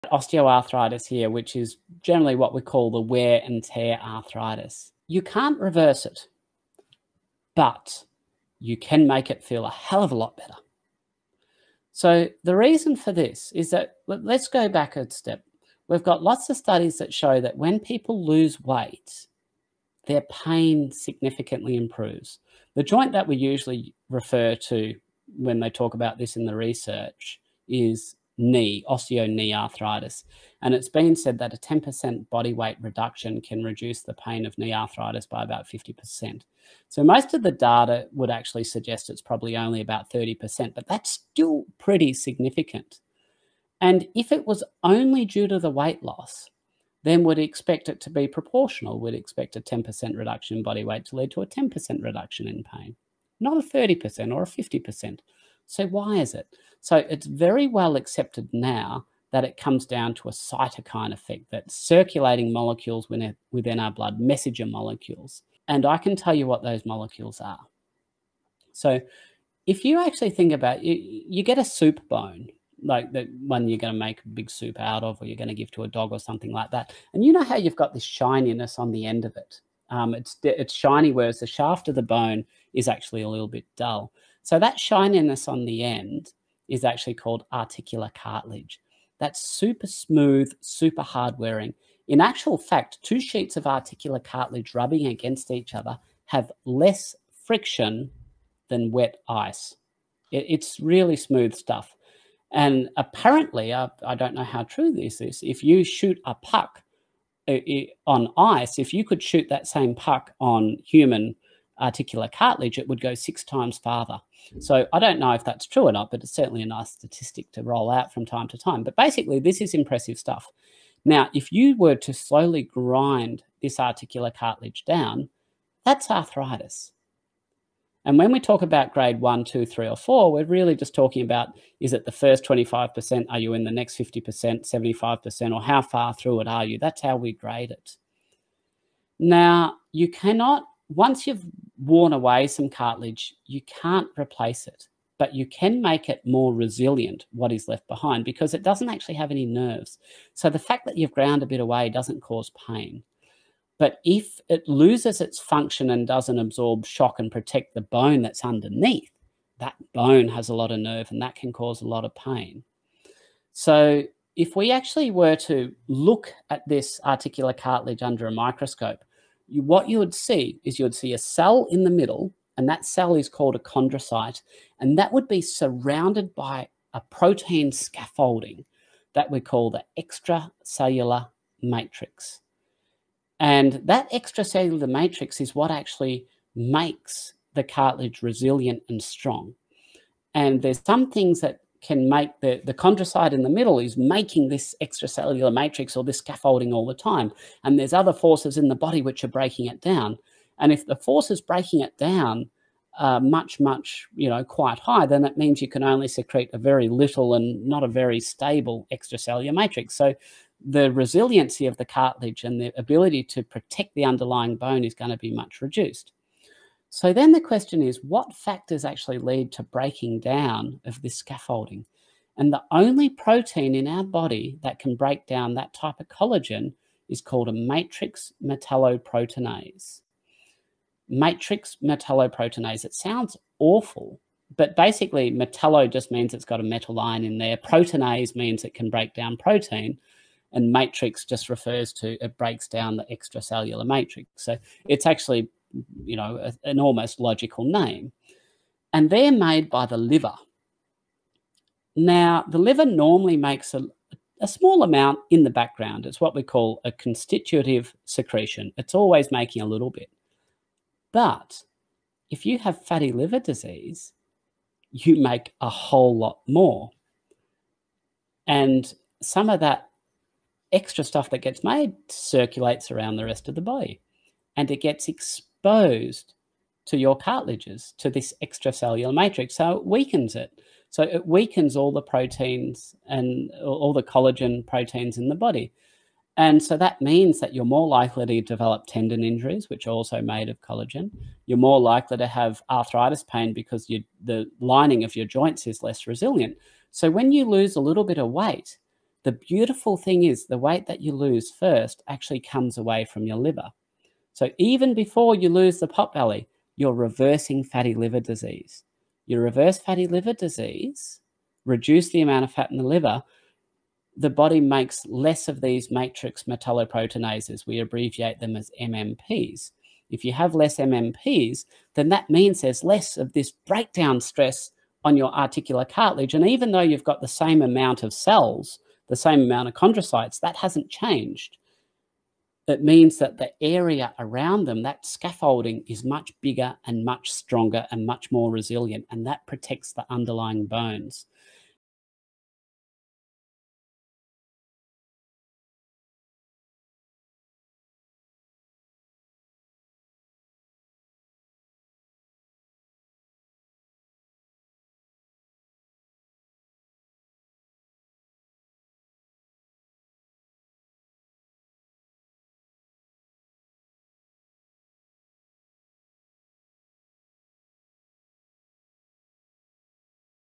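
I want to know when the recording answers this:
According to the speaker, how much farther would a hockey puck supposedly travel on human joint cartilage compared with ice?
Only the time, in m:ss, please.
1:53.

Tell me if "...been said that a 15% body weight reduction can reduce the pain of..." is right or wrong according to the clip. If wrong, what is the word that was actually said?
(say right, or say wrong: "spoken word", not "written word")
wrong: "10", not "15".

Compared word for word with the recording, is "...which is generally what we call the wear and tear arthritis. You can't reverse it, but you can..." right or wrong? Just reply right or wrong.
right.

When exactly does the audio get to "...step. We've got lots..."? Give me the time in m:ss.
0:15.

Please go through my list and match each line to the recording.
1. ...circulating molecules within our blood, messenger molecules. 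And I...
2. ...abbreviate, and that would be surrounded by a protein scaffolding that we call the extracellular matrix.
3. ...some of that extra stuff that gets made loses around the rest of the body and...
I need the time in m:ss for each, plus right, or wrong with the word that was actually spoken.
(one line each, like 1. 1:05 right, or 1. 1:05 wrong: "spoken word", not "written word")
1. 1:01 right
2. 2:53 wrong: "chondrocyte", not "abbreviate"
3. 4:29 wrong: "circulates", not "loses".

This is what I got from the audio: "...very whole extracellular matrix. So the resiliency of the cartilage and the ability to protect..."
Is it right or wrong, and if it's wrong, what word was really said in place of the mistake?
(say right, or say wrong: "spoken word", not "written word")
wrong: "stable", not "whole".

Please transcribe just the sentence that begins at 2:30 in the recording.
So the fact that you've ground a bit away doesn't cause pain.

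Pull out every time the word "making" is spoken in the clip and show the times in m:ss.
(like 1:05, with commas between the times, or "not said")
3:13, 4:19.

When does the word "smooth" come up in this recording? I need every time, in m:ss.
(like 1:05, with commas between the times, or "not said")
1:29, 1:41.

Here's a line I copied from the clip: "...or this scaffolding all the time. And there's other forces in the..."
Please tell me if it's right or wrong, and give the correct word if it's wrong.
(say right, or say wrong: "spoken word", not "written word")
right.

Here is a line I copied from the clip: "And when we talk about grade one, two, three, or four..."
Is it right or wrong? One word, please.
right.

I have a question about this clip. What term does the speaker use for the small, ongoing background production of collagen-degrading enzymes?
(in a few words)
constitutive secretion.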